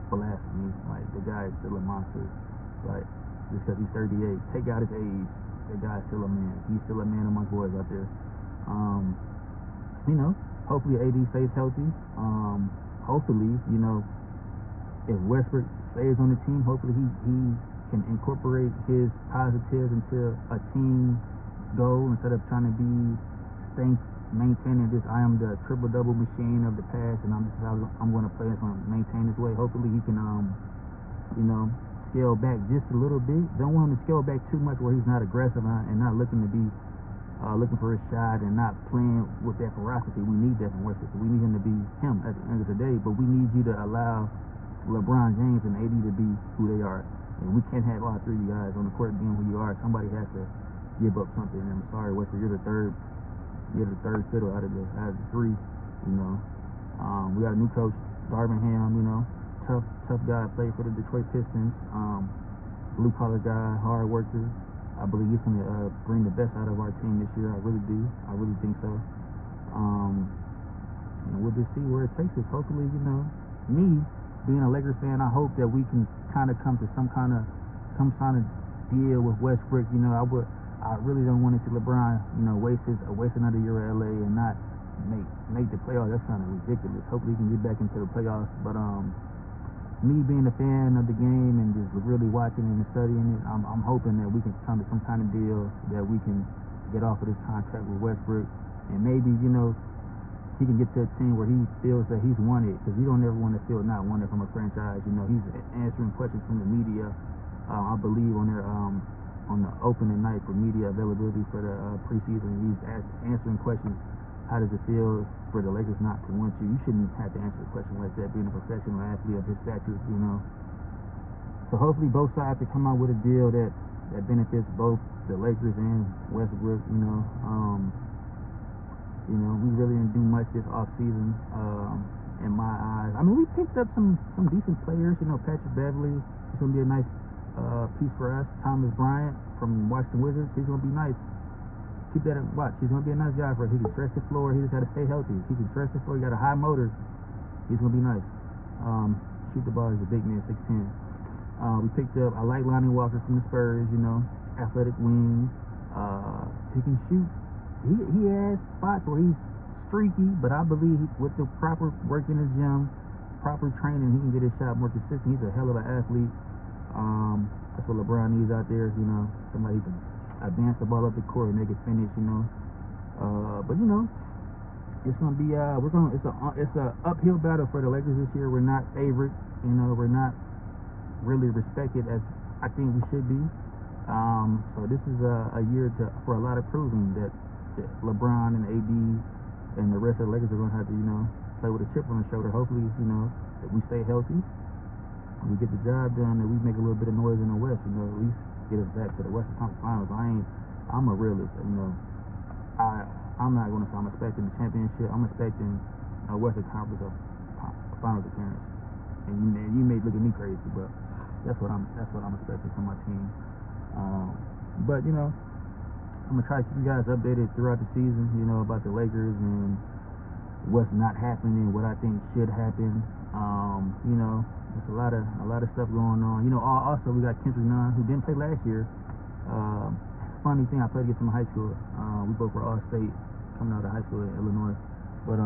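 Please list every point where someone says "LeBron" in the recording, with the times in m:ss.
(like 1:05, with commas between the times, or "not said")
0:44, 1:21, 2:47, 3:08.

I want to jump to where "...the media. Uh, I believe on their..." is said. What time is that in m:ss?
1:46.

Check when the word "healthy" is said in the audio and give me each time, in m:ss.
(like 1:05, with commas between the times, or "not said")
0:11, 2:25, 3:14.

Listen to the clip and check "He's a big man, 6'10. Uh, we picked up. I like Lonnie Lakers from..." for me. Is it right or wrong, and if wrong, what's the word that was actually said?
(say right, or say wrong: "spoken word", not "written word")
wrong: "Walker", not "Lakers".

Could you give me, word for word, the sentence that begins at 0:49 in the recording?
Somebody has to give up something.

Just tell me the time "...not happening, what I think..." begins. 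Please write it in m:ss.
3:40.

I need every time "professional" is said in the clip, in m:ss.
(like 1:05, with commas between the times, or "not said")
1:58.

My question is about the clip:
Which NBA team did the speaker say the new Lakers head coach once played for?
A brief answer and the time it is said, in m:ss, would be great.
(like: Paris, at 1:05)
Detroit Pistons, at 1:00.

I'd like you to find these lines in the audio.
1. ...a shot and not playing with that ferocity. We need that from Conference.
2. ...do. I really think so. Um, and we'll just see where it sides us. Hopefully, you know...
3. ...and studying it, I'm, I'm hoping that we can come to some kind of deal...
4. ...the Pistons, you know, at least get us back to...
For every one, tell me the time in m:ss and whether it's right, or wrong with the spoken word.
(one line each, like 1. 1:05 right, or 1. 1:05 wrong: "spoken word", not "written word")
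1. 0:37 wrong: "Westbrook", not "Conference"
2. 1:07 wrong: "takes", not "sides"
3. 1:32 right
4. 3:17 wrong: "West", not "Pistons".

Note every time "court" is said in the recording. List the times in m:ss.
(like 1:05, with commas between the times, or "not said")
0:48, 2:51.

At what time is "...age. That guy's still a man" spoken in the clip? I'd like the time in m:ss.
0:04.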